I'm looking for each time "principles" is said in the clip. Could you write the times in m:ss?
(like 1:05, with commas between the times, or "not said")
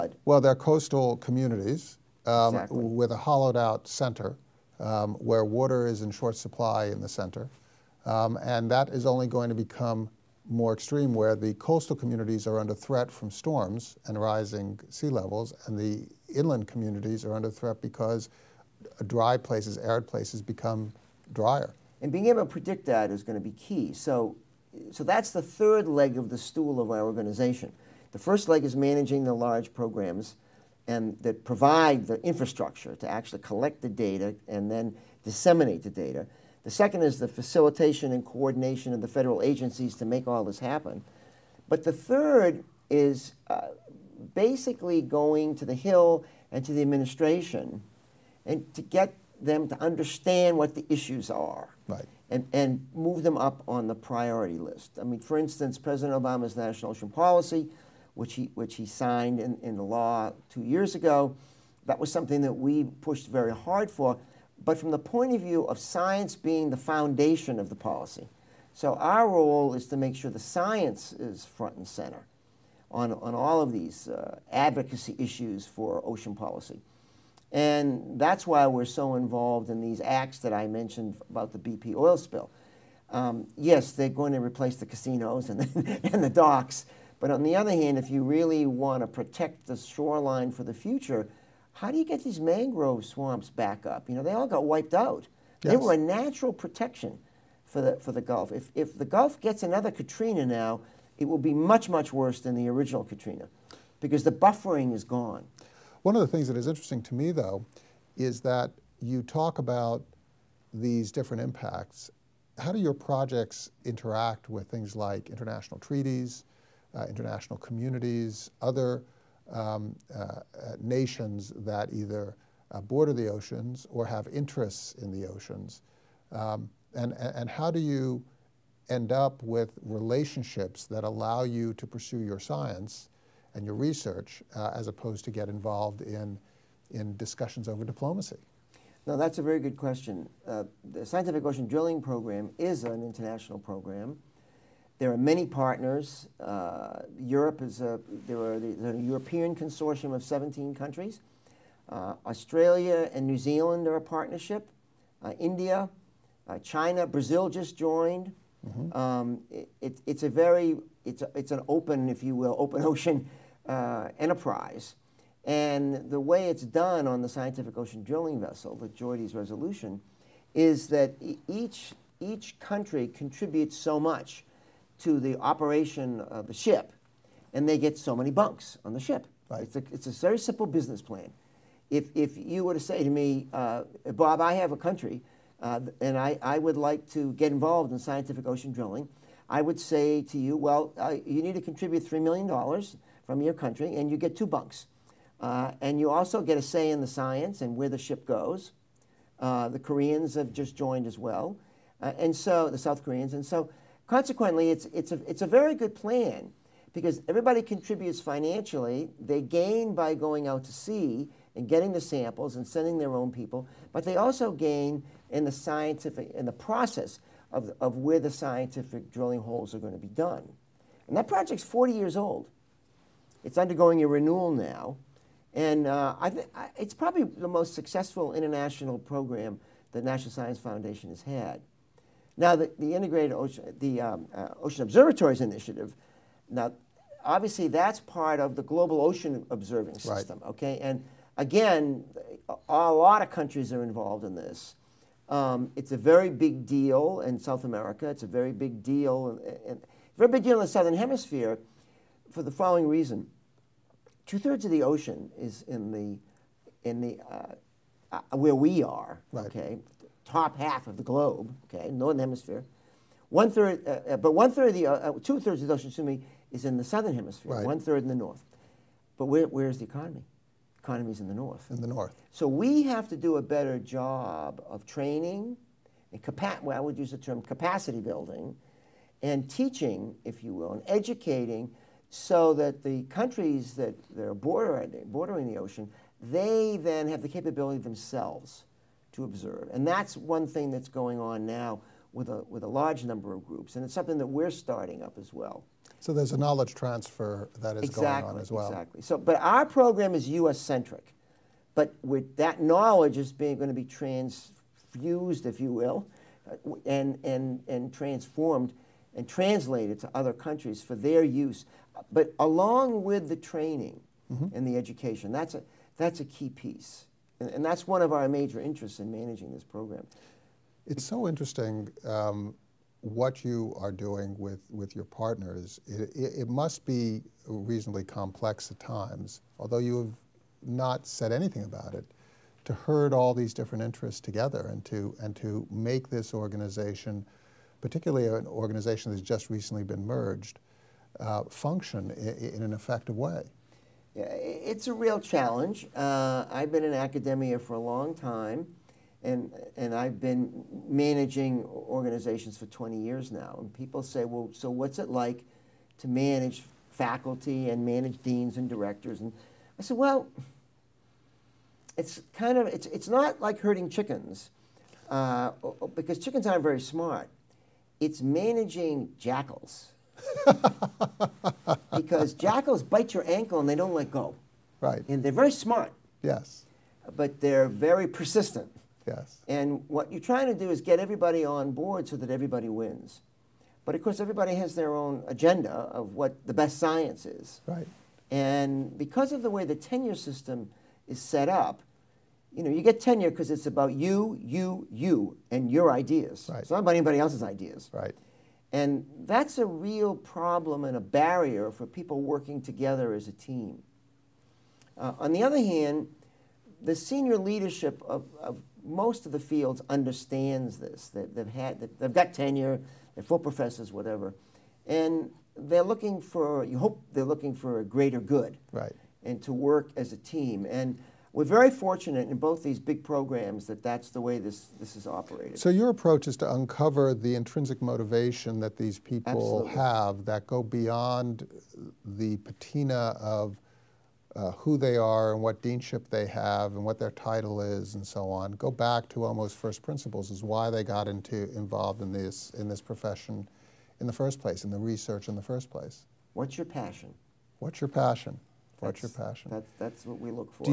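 7:19.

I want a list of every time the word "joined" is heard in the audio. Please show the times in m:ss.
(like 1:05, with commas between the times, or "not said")
2:37, 3:20.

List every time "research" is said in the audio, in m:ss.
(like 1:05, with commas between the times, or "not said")
2:13, 7:24.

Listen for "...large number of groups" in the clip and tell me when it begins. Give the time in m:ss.
4:52.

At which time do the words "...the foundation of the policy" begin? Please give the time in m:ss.
1:06.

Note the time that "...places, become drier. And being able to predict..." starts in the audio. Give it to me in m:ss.
0:20.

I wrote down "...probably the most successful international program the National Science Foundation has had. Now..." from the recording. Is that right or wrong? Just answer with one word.
right.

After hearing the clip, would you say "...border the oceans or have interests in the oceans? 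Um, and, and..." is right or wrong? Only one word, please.
right.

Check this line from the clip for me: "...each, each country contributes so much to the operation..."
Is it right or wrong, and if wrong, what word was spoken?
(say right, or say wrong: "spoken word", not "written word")
right.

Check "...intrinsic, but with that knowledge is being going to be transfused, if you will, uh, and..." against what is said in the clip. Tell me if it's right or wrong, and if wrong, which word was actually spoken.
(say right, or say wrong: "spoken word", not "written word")
wrong: "centric", not "intrinsic".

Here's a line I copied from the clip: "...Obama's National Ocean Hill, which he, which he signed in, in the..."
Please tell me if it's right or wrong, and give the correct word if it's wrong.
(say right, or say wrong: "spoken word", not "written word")
wrong: "Policy", not "Hill".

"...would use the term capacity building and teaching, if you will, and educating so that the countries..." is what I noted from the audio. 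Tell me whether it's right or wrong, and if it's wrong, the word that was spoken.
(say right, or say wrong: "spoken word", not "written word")
right.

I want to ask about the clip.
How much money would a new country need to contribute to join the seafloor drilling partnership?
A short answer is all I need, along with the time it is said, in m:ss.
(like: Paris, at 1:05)
$3 million, at 3:12.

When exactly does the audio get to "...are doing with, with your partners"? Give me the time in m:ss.
5:23.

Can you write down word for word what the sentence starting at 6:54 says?
And they're looking for, you hope they're looking for a greater good.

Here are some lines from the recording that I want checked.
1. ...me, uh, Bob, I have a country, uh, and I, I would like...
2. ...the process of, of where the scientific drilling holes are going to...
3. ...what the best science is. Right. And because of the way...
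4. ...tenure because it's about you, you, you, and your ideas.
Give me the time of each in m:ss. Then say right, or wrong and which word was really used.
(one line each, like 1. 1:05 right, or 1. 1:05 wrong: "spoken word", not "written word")
1. 3:03 right
2. 3:36 right
3. 6:26 right
4. 6:32 right.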